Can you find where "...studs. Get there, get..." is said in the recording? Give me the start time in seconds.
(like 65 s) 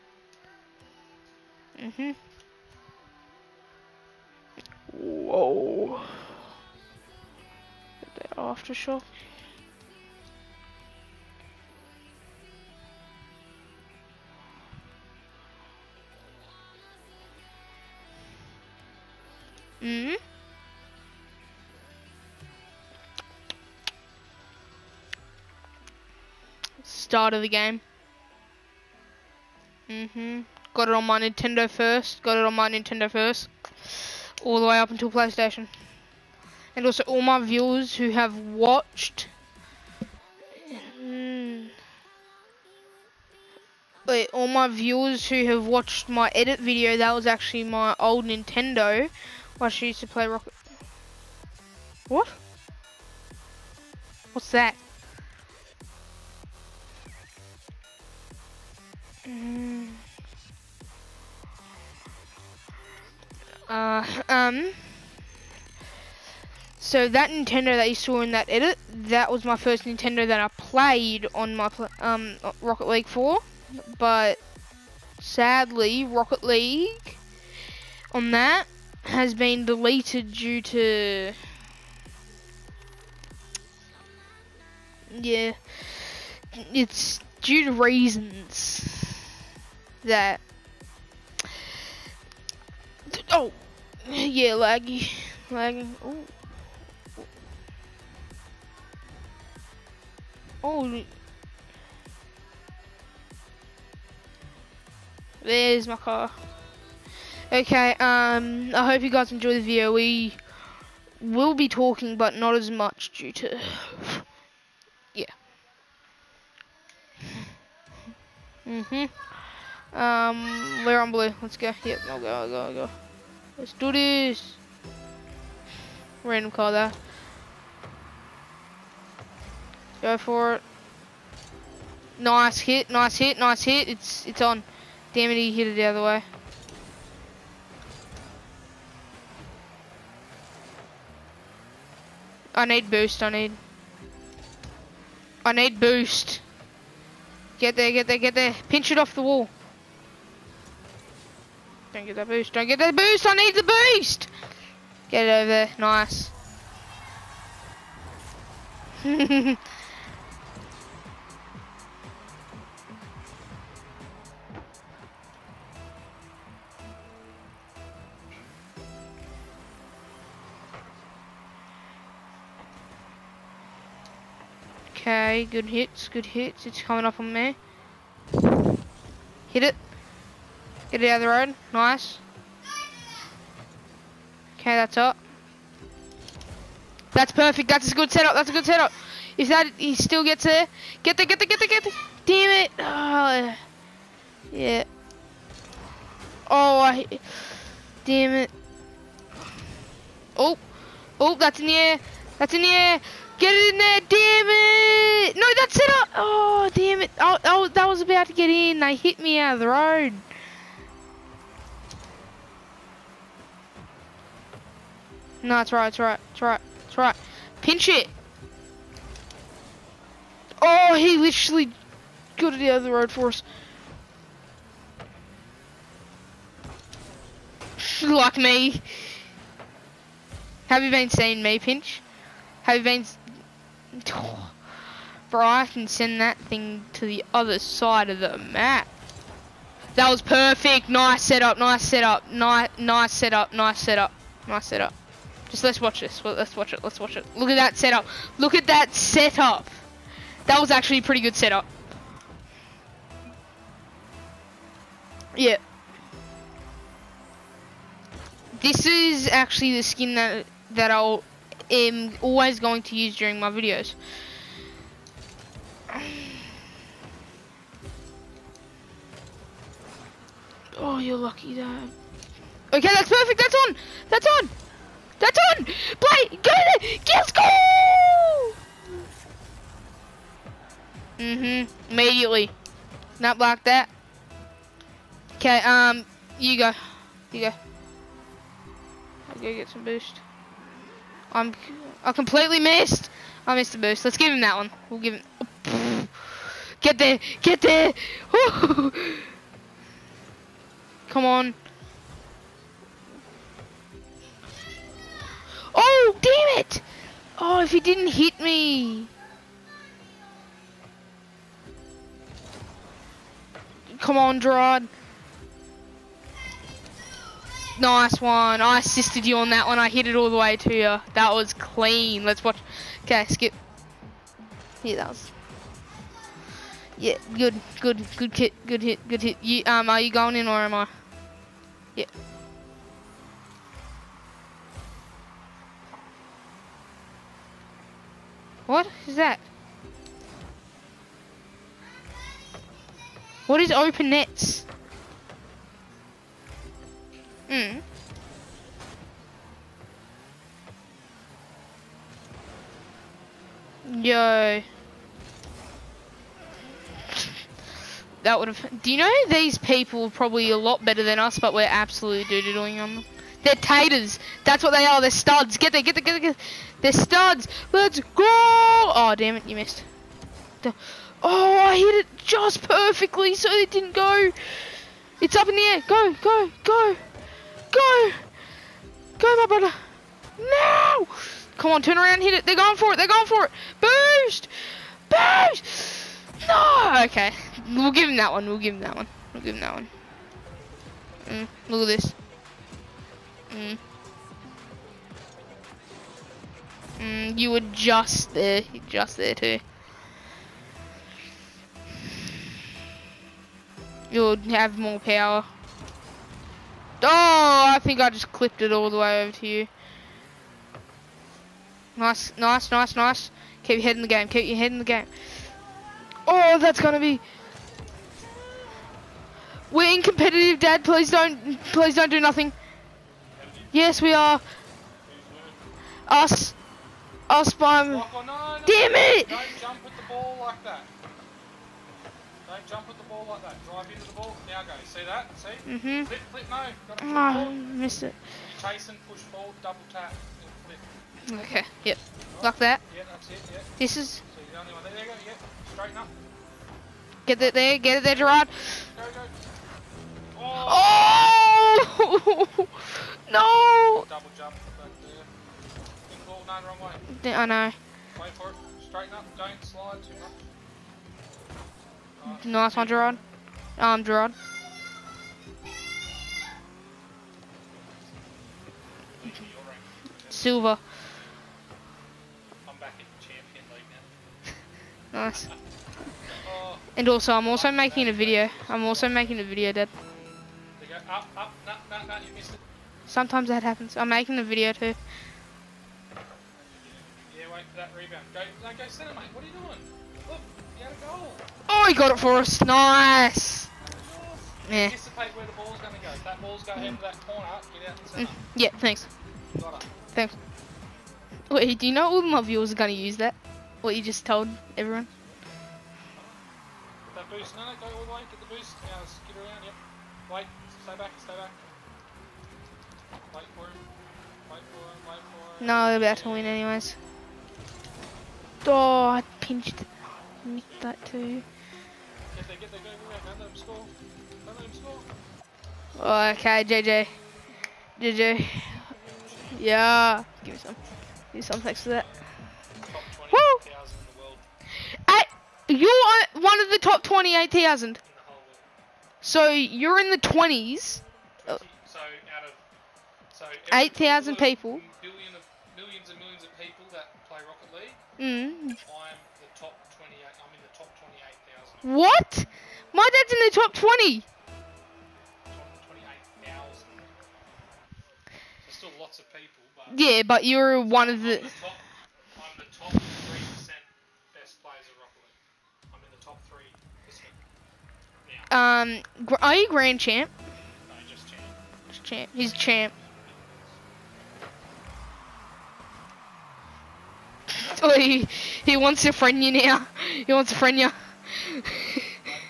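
365 s.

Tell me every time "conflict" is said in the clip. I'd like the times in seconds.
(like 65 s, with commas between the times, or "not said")
not said.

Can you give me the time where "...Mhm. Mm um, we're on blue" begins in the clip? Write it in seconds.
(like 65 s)
118 s.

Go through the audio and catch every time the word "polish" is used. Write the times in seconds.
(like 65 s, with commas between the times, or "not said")
not said.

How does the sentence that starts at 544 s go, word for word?
of, millions and millions of people that play Rocket League.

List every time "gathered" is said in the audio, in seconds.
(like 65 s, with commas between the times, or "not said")
not said.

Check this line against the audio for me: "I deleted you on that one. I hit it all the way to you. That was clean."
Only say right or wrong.
wrong.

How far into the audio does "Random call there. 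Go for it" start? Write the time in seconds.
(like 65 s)
126 s.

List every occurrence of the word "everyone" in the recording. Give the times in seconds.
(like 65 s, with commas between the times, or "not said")
504 s.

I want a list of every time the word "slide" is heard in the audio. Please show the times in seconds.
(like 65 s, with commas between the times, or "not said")
459 s.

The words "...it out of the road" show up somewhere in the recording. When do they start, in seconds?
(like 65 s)
181 s.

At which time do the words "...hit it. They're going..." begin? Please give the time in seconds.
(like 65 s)
382 s.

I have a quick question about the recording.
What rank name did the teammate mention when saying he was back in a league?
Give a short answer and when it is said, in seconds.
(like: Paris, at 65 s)
Champion League, at 473 s.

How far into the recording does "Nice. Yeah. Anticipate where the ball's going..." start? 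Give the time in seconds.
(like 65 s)
492 s.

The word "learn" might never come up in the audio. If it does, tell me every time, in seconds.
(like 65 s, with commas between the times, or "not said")
not said.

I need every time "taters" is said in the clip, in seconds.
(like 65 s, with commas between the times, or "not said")
363 s.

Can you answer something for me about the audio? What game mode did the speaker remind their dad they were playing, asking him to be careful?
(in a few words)
Competitive.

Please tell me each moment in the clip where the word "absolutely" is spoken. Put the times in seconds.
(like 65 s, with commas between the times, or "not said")
361 s.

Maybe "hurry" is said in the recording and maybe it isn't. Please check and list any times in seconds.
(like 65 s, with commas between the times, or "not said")
not said.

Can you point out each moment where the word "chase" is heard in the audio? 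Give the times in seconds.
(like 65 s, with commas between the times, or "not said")
438 s.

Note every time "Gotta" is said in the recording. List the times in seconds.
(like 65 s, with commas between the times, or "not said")
436 s.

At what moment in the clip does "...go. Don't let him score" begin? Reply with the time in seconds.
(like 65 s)
523 s.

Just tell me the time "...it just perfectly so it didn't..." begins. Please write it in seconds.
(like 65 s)
371 s.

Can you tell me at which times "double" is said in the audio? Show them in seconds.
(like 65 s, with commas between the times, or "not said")
439 s, 454 s.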